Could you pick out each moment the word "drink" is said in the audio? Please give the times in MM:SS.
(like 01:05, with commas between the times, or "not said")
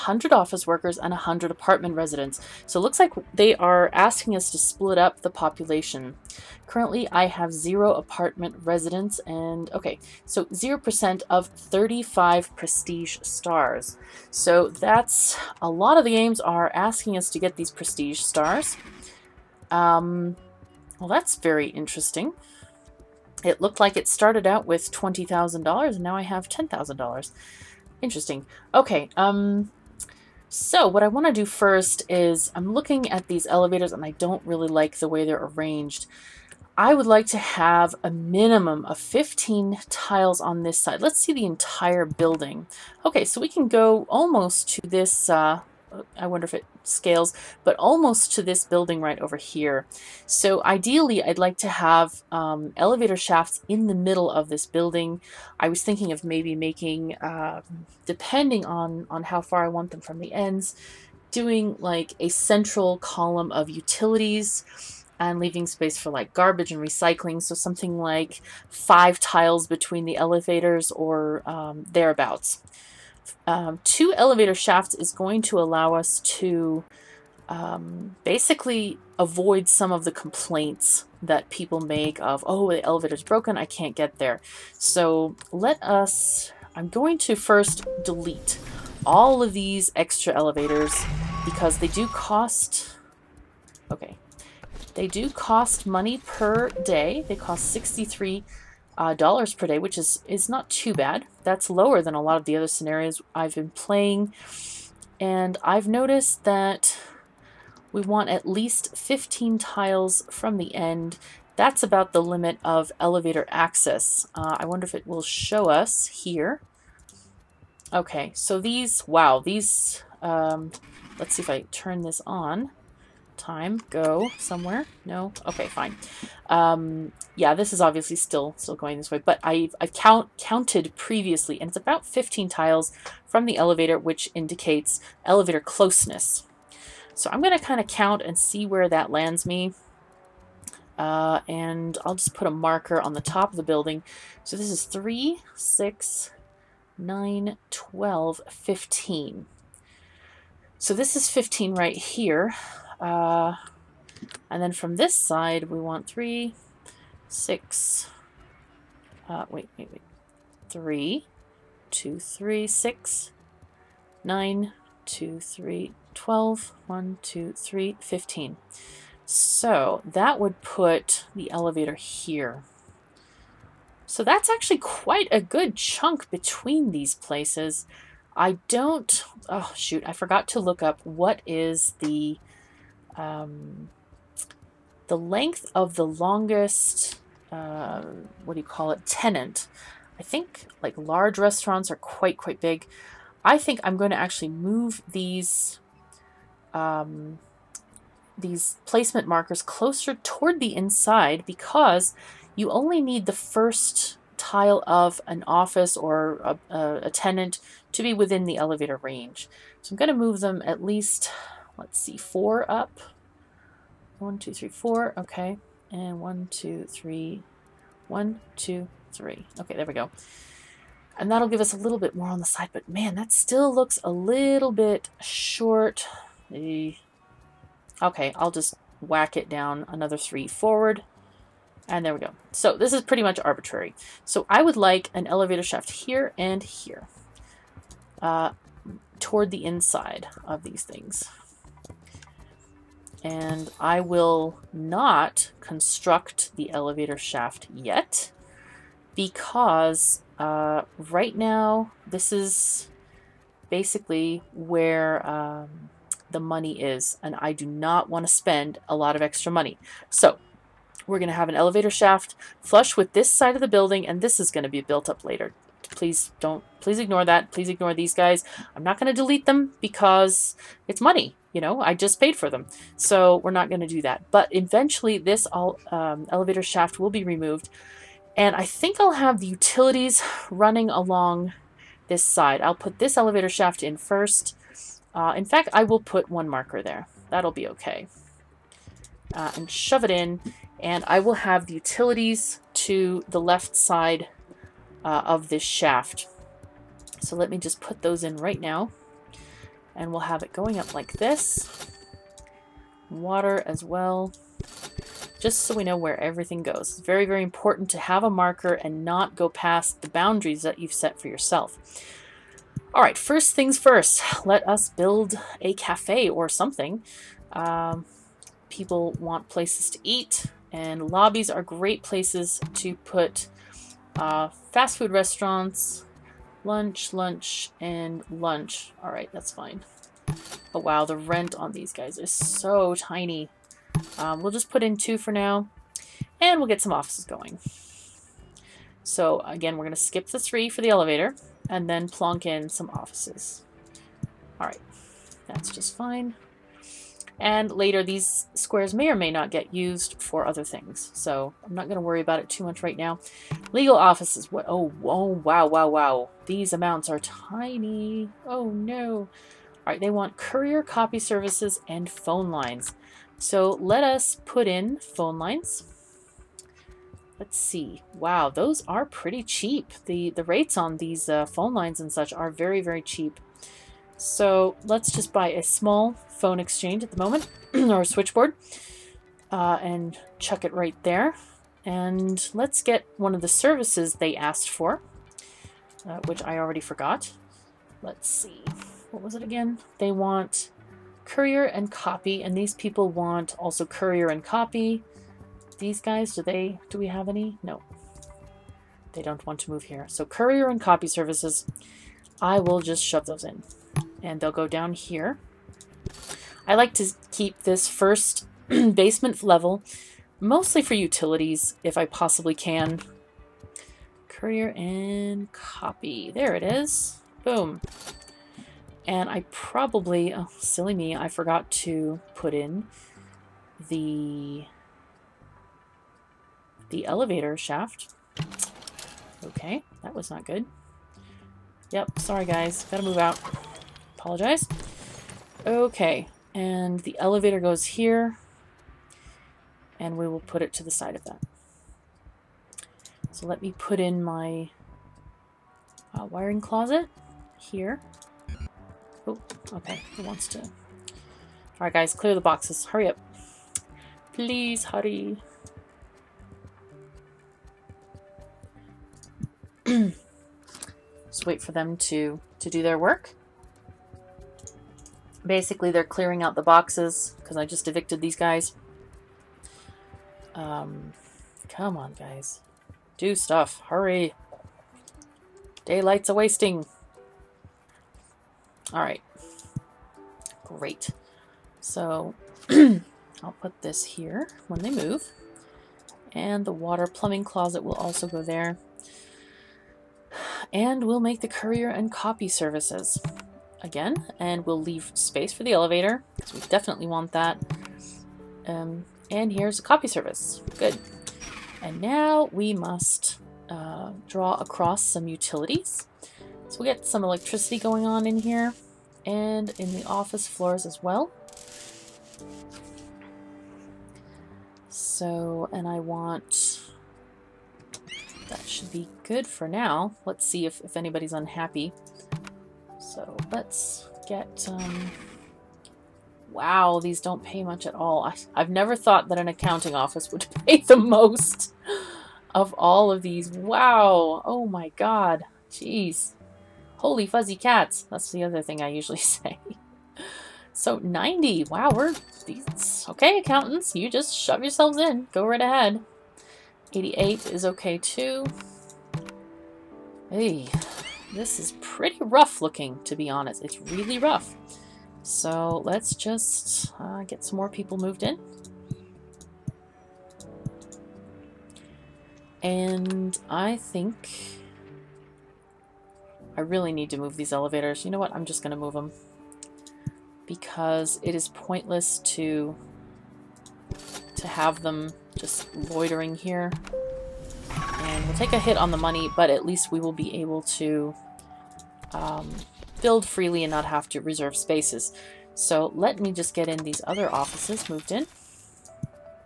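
not said.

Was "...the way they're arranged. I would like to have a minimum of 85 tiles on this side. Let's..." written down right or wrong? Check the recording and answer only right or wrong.
wrong.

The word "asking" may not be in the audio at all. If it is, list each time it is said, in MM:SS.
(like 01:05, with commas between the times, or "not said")
00:03, 00:16.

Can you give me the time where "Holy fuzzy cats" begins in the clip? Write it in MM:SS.
08:56.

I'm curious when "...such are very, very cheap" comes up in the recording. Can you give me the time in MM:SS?
06:12.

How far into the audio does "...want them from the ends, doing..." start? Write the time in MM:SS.
00:59.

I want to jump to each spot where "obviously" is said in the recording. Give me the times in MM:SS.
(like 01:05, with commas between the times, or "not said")
02:07.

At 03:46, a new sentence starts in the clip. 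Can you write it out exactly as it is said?
Okay, I'll just whack it down another three forward.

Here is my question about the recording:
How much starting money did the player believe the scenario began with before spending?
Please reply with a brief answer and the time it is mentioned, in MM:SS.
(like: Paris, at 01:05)
$20,000, at 00:24.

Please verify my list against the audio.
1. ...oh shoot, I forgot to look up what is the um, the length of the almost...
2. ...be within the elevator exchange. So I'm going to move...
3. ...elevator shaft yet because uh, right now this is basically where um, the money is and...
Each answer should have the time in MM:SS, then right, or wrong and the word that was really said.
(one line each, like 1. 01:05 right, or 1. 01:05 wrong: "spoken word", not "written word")
1. 02:59 wrong: "longest", not "almost"
2. 03:28 wrong: "range", not "exchange"
3. 04:06 right.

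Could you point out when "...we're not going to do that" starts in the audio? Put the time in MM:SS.
04:33.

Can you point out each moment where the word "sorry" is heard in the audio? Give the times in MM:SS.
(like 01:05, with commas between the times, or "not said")
07:12.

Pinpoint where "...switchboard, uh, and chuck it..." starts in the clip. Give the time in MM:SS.
06:18.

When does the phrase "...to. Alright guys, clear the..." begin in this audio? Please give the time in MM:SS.
07:30.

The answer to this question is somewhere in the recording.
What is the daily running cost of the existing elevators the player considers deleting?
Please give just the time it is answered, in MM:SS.
01:37.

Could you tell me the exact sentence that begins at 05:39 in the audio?
So again, we're going to skip the three for the elevator, and then plonk in some offices.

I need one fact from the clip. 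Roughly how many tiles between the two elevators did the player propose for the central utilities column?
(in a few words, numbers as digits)
5.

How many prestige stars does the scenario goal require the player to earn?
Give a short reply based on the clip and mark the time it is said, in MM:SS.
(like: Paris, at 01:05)
35, at 00:11.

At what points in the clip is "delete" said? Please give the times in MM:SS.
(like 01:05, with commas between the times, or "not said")
01:28, 04:29.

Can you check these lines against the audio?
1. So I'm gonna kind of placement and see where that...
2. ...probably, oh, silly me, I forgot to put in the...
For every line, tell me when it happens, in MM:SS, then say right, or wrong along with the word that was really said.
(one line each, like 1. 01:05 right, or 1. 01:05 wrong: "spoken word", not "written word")
1. 02:17 wrong: "count", not "placement"
2. 06:59 right.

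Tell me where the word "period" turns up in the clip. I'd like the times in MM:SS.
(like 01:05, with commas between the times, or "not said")
not said.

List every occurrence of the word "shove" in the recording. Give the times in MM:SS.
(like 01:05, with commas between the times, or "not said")
04:49, 06:43, 09:04.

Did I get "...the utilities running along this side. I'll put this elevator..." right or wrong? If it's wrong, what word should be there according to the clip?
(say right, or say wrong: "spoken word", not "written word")
right.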